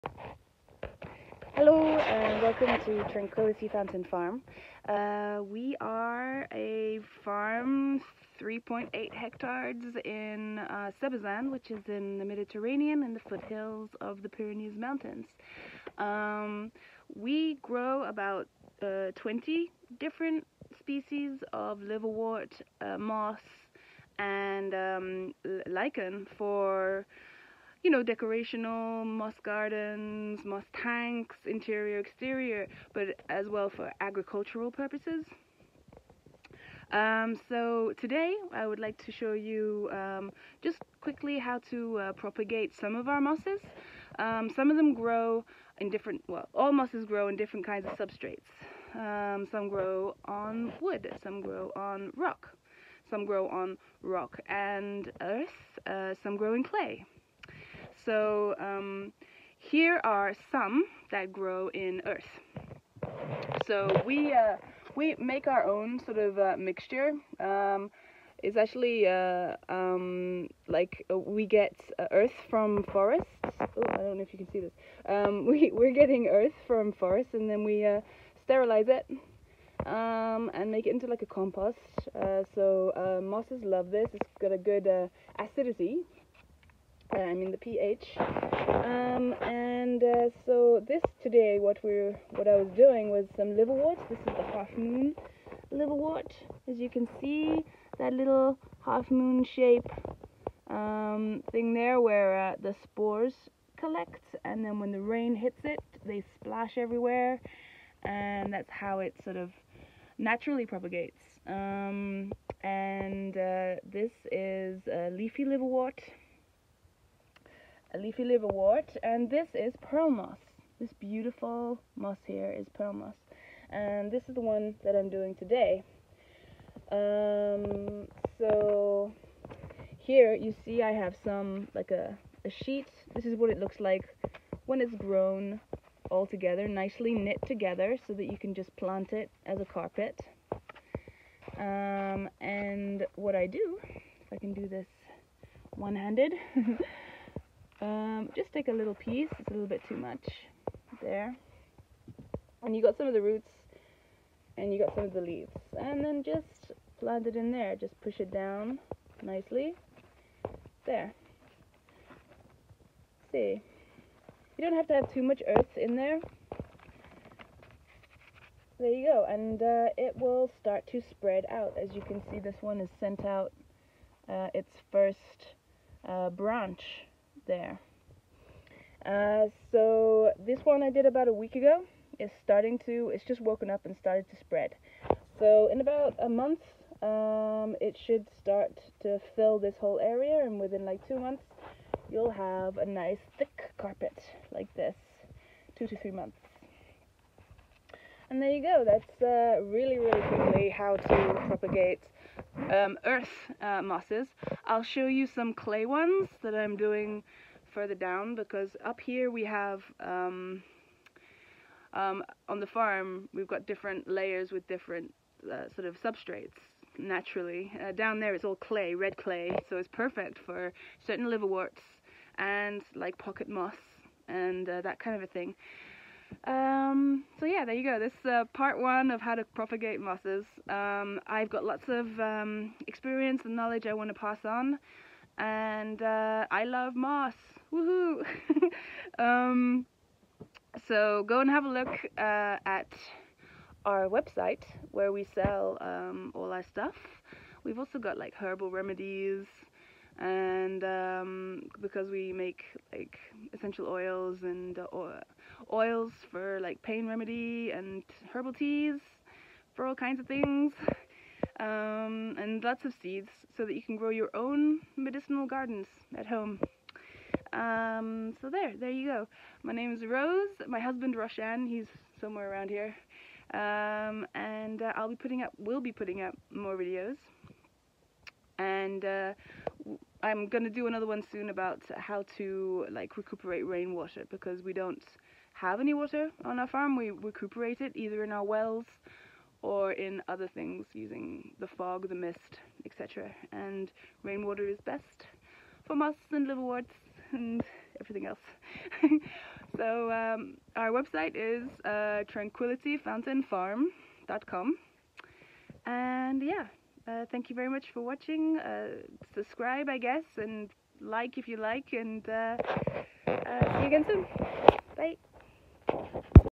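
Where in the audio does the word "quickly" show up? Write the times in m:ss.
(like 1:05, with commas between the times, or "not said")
0:40, 3:20.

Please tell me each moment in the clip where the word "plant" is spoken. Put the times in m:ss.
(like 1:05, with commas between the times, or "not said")
2:18, 2:36.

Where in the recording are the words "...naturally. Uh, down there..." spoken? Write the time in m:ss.
3:36.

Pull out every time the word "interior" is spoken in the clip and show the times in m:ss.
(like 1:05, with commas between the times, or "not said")
0:31.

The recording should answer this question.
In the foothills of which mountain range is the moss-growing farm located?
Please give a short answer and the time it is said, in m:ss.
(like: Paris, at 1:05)
Pyrenees, at 0:14.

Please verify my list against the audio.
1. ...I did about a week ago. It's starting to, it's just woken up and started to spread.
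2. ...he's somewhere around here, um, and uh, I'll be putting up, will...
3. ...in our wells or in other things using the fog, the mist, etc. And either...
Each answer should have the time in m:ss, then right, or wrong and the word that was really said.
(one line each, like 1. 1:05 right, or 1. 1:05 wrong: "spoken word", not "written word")
1. 3:00 right
2. 4:31 right
3. 4:48 wrong: "rainwater", not "either".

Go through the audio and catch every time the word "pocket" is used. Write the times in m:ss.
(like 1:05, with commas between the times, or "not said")
3:43.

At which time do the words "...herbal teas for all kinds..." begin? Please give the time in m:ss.
4:18.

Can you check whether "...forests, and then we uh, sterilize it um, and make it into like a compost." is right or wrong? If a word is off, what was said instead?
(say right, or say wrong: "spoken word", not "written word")
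right.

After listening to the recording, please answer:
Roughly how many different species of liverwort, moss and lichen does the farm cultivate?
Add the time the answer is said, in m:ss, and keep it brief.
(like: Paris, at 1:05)
20, at 0:19.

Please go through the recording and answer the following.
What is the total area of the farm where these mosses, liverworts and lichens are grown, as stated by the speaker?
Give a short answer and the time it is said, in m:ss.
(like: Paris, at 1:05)
3.8 hectares, at 0:08.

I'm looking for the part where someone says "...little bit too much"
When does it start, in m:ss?
2:29.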